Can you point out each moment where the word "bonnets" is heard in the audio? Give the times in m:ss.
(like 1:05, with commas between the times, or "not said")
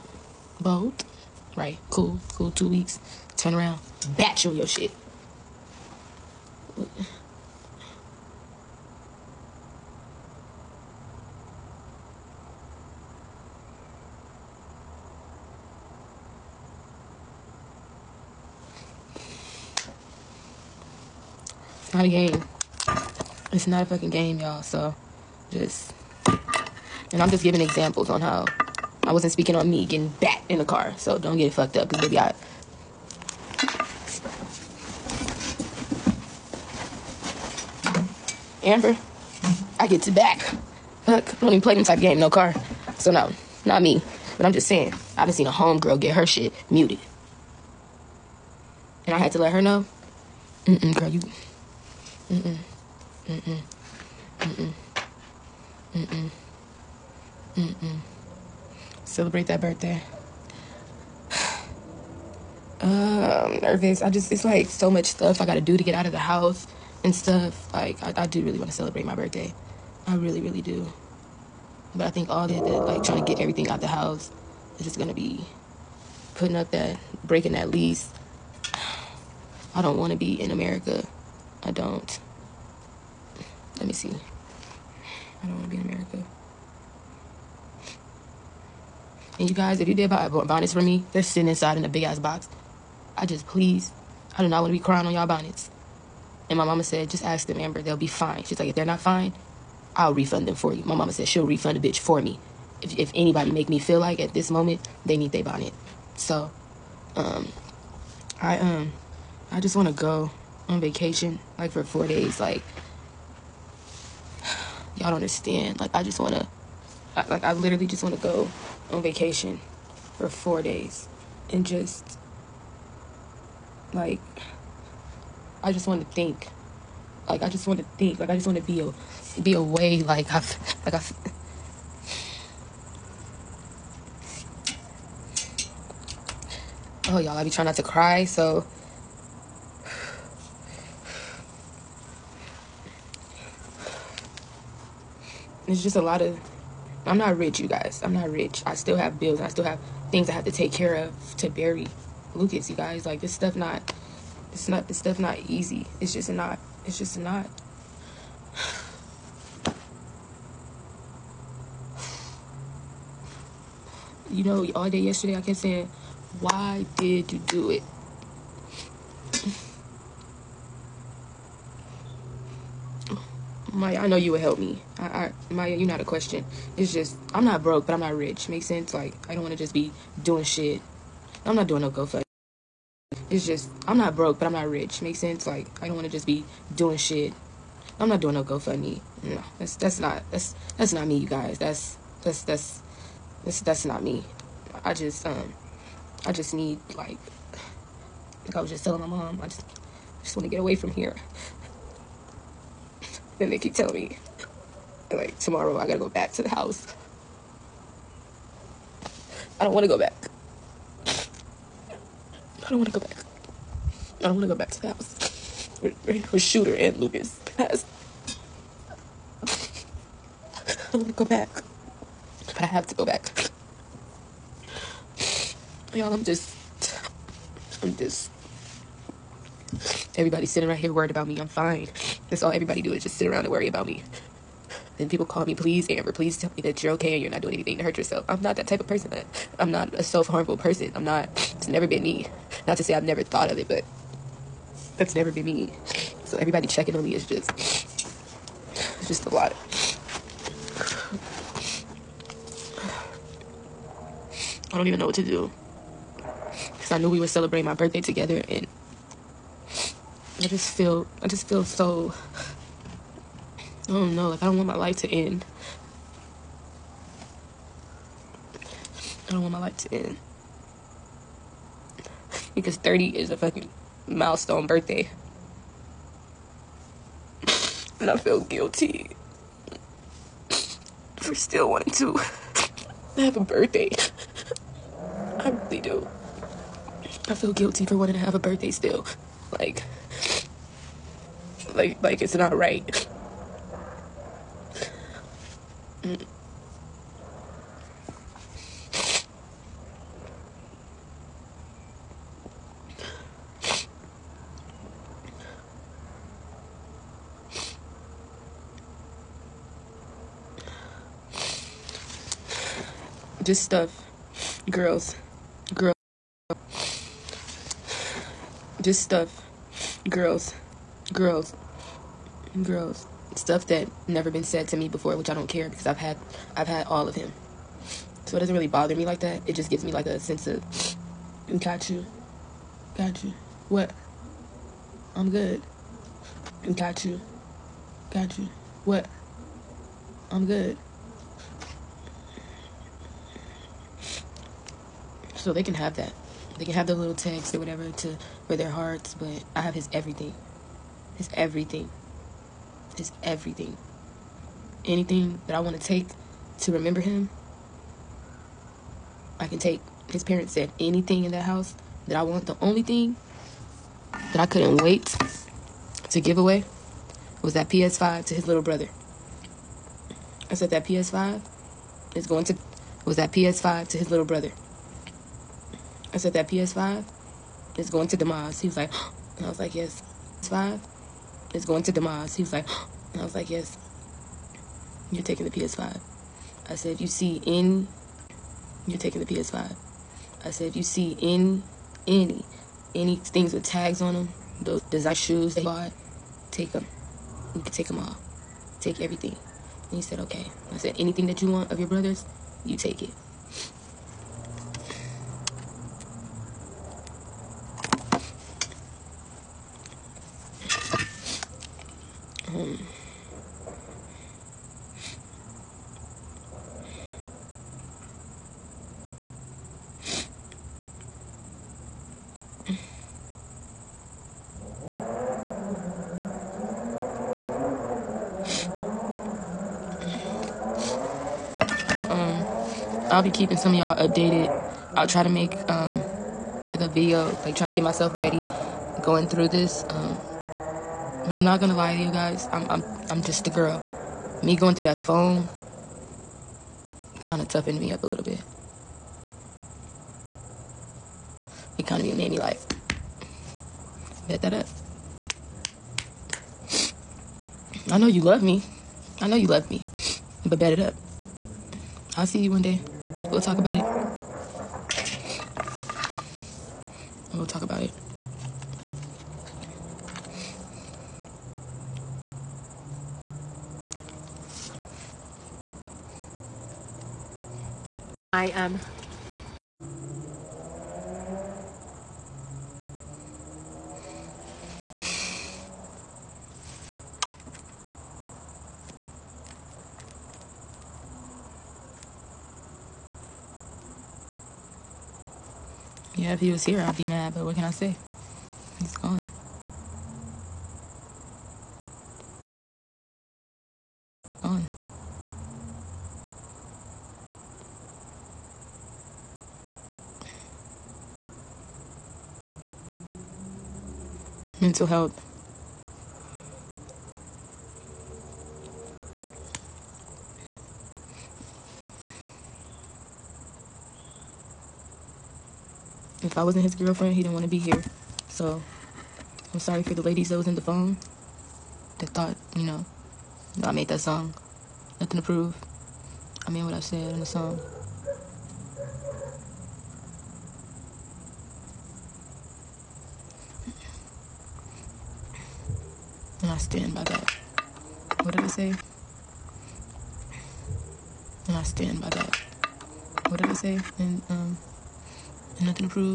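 1:30, 1:35, 1:45.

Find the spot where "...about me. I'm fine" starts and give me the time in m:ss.
3:51.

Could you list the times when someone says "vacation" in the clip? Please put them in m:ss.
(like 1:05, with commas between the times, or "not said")
1:50, 1:59.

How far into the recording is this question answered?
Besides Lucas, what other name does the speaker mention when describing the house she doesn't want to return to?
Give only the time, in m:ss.
3:36.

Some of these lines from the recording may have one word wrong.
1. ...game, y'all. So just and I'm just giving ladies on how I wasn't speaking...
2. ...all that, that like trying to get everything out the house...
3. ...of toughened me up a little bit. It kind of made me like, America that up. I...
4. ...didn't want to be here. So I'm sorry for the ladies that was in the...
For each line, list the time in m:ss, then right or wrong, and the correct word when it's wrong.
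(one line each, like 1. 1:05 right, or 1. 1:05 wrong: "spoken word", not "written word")
1. 0:24 wrong: "examples", not "ladies"
2. 1:12 right
3. 7:27 wrong: "Bet", not "America"
4. 8:47 right.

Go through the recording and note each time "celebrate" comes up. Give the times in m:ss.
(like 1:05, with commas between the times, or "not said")
0:59, 1:08, 4:17.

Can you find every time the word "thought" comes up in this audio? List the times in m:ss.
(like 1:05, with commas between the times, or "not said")
4:03, 8:52.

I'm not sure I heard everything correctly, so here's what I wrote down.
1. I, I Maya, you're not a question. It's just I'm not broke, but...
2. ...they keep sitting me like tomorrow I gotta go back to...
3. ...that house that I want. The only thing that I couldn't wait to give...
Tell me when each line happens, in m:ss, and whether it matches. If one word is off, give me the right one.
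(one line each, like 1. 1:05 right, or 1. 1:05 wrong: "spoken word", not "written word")
1. 2:54 right
2. 3:23 wrong: "telling", not "sitting"
3. 6:01 right.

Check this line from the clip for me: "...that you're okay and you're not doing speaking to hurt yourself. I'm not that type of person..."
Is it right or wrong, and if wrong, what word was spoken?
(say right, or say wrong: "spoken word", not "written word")
wrong: "anything", not "speaking".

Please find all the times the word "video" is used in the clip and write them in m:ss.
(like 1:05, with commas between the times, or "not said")
7:16.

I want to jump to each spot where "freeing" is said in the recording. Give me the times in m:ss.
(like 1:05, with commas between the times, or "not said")
not said.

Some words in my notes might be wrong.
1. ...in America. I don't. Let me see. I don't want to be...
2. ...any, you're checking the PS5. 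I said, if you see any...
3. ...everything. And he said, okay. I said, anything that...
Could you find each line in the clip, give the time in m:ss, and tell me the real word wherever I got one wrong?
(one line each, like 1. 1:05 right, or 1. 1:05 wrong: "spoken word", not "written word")
1. 1:20 right
2. 6:27 wrong: "taking", not "checking"
3. 6:38 right.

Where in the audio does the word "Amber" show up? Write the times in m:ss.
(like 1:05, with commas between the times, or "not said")
0:38, 1:37, 3:55.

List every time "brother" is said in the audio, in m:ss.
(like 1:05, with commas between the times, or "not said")
6:08, 6:14, 6:41.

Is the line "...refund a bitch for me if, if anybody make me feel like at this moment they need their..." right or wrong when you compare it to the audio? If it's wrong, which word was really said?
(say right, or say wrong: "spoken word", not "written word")
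right.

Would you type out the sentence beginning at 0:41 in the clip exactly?
Fuck don't even play them type game, no car.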